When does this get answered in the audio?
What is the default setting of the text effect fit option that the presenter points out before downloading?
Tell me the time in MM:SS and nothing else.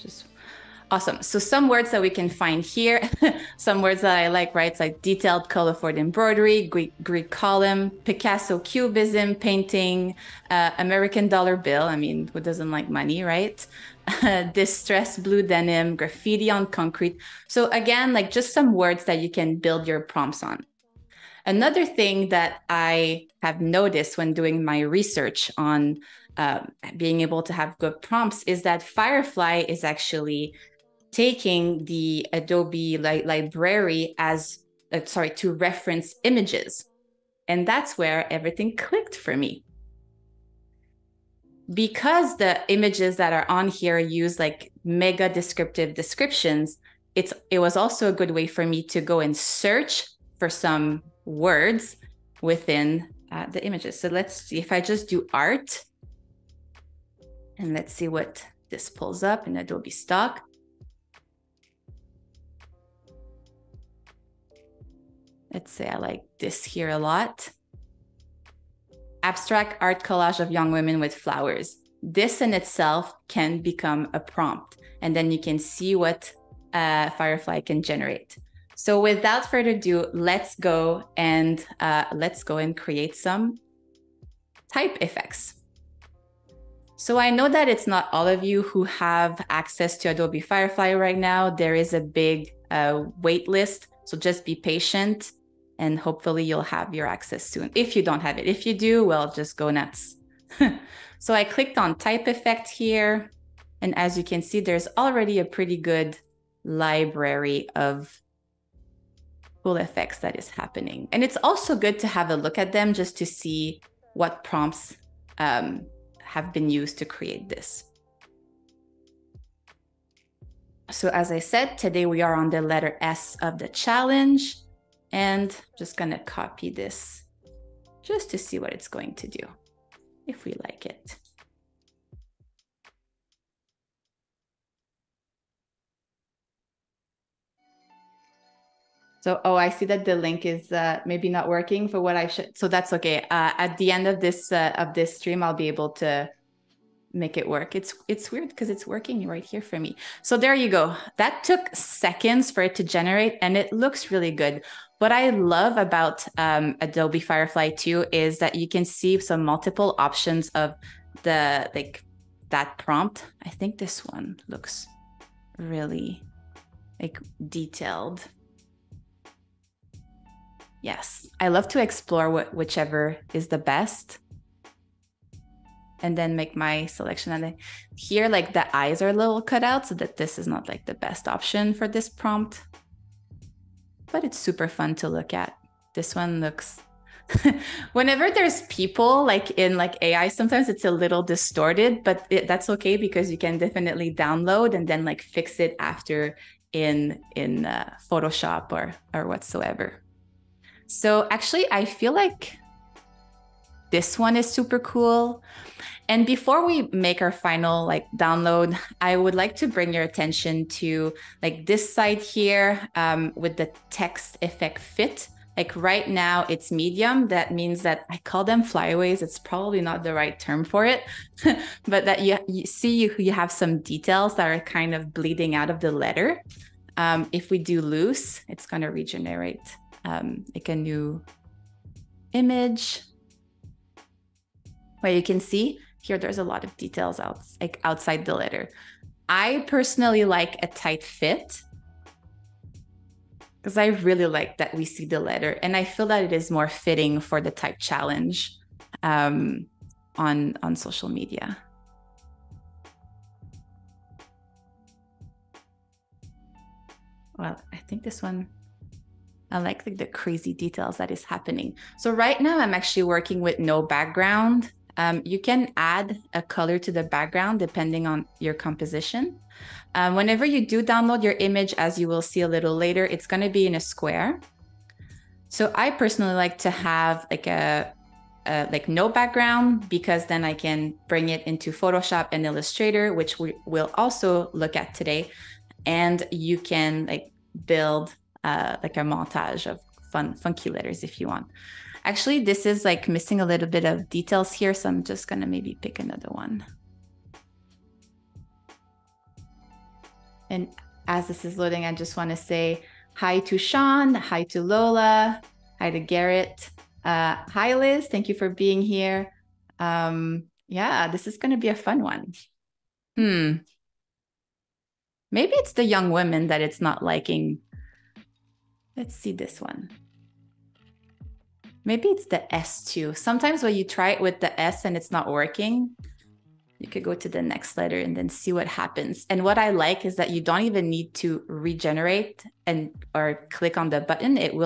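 03:36.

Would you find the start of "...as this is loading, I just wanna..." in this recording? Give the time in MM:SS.
05:01.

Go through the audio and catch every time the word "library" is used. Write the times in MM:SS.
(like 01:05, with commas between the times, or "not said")
00:33, 01:46.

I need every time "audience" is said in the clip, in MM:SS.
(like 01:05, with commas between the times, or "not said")
not said.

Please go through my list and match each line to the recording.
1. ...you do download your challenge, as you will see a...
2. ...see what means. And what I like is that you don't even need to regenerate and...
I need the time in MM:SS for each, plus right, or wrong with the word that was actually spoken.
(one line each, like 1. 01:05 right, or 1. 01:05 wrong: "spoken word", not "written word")
1. 04:30 wrong: "image", not "challenge"
2. 05:28 wrong: "happens", not "means".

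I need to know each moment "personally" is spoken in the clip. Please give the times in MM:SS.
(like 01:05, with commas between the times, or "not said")
03:59, 04:35.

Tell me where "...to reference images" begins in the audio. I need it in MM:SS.
00:35.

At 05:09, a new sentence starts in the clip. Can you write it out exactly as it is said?
Um, yeah, this is gonna be a fun one.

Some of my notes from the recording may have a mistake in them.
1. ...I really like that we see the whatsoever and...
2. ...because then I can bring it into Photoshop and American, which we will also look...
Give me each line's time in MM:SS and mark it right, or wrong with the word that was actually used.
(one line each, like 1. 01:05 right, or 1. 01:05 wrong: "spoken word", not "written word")
1. 04:03 wrong: "letter", not "whatsoever"
2. 04:39 wrong: "Illustrator", not "American".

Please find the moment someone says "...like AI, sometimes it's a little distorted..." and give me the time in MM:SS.
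03:09.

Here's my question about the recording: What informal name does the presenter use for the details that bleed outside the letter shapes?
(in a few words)
Flyaways.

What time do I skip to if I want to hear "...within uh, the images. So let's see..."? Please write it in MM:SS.
00:52.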